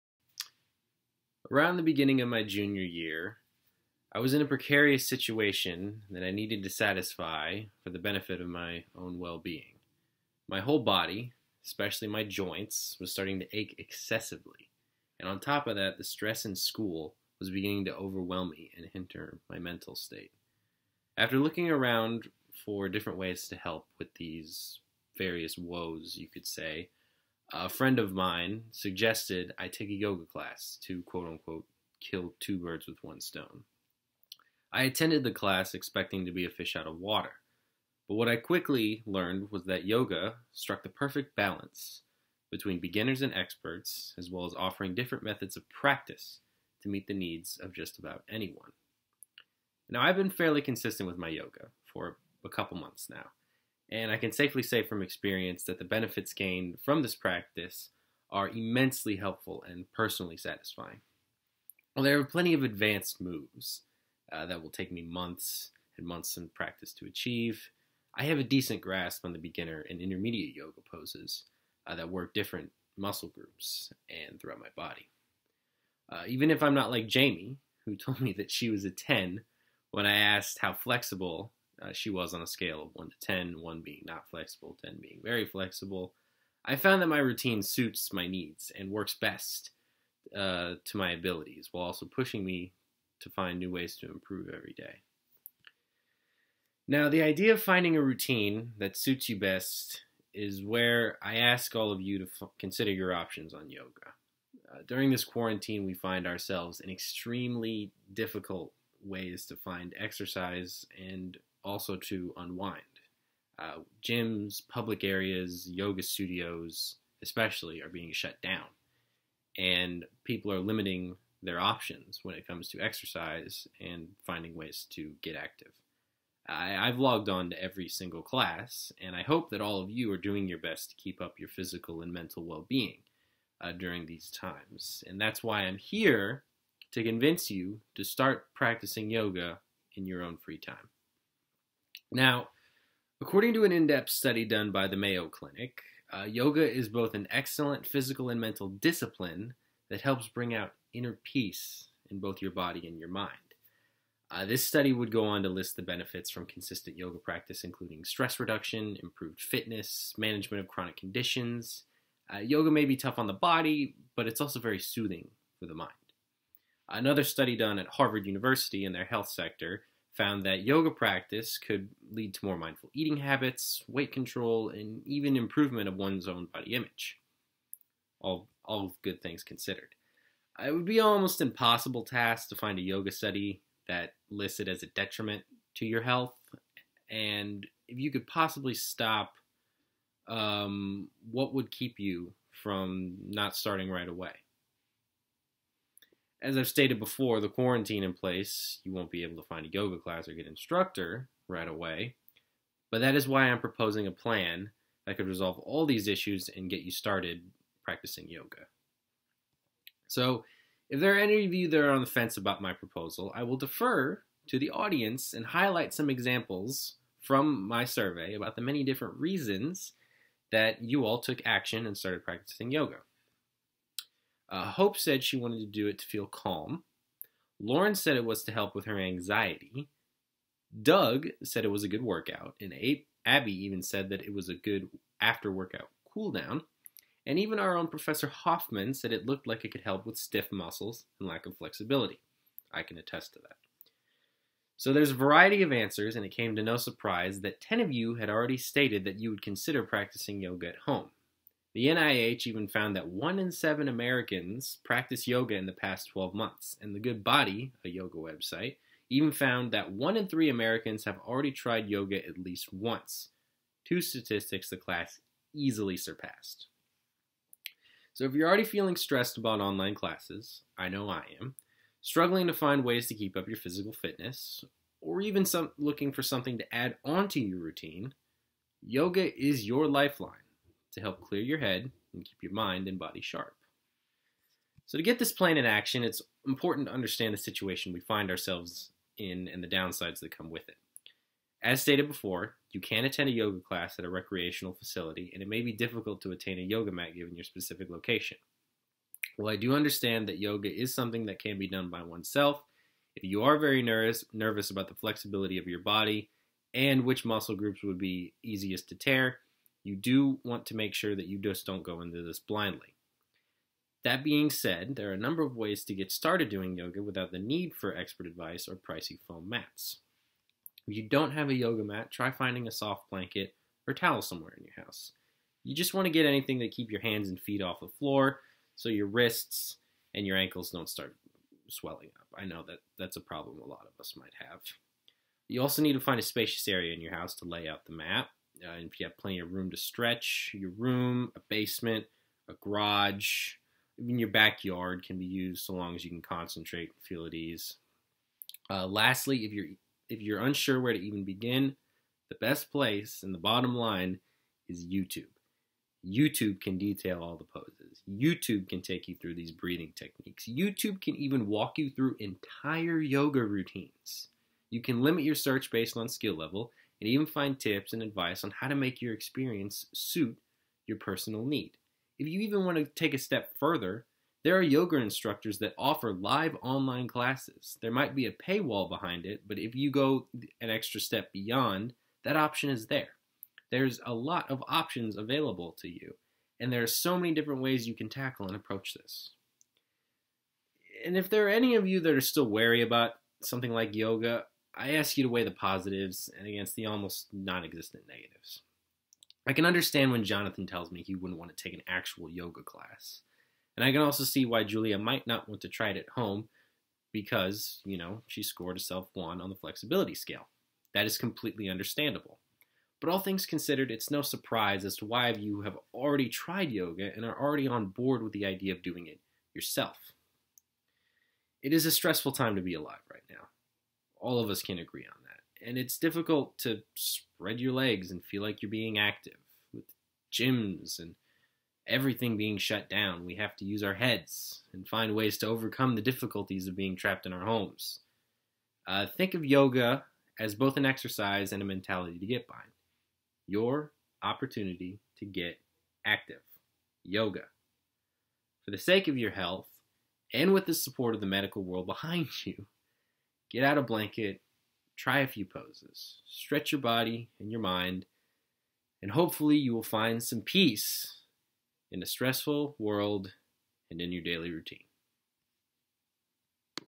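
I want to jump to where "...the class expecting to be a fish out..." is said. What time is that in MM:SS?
00:35.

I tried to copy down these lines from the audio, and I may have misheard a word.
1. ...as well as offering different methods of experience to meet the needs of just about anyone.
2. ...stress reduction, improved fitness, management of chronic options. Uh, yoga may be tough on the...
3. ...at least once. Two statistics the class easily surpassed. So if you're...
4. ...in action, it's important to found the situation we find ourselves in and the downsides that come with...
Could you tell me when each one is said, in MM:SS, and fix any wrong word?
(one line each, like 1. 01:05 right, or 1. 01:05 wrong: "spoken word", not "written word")
1. 00:44 wrong: "practice", not "experience"
2. 02:38 wrong: "conditions", not "options"
3. 04:22 right
4. 04:45 wrong: "understand", not "found".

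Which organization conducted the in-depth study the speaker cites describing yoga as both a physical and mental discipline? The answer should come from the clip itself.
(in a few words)
Mayo Clinic.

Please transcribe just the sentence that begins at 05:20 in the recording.
If you don't have a yoga mat, try finding a soft blanket or towel somewhere in your house.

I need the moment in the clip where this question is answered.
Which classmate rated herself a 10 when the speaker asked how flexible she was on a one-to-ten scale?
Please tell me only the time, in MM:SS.
01:17.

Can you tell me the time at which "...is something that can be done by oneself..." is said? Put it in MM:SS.
05:00.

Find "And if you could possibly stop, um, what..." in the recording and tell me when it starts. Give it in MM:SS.
03:07.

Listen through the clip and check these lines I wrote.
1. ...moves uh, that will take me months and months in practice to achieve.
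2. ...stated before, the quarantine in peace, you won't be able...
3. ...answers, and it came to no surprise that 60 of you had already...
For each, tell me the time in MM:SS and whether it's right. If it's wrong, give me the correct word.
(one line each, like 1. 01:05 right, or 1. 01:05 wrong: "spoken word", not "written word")
1. 01:03 right
2. 03:16 wrong: "place", not "peace"
3. 04:05 wrong: "10", not "60".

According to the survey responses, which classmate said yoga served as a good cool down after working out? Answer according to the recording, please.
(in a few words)
Abby.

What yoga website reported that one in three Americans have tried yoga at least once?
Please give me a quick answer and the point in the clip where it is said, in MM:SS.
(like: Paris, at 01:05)
the Good Body, at 04:16.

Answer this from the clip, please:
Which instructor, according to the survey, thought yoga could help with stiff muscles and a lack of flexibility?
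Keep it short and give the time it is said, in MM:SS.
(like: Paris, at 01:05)
Professor Hoffman, at 03:57.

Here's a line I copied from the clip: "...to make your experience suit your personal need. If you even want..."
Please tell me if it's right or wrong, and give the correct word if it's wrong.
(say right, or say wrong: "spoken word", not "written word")
right.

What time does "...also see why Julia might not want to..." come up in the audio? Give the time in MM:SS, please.
06:44.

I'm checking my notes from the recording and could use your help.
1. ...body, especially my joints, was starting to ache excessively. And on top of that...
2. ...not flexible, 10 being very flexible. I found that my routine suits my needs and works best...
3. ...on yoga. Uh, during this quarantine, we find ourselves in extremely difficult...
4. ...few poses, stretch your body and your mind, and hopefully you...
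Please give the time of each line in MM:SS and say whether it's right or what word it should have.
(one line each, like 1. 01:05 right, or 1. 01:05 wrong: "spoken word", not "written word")
1. 00:10 right
2. 01:24 right
3. 01:43 right
4. 07:35 right.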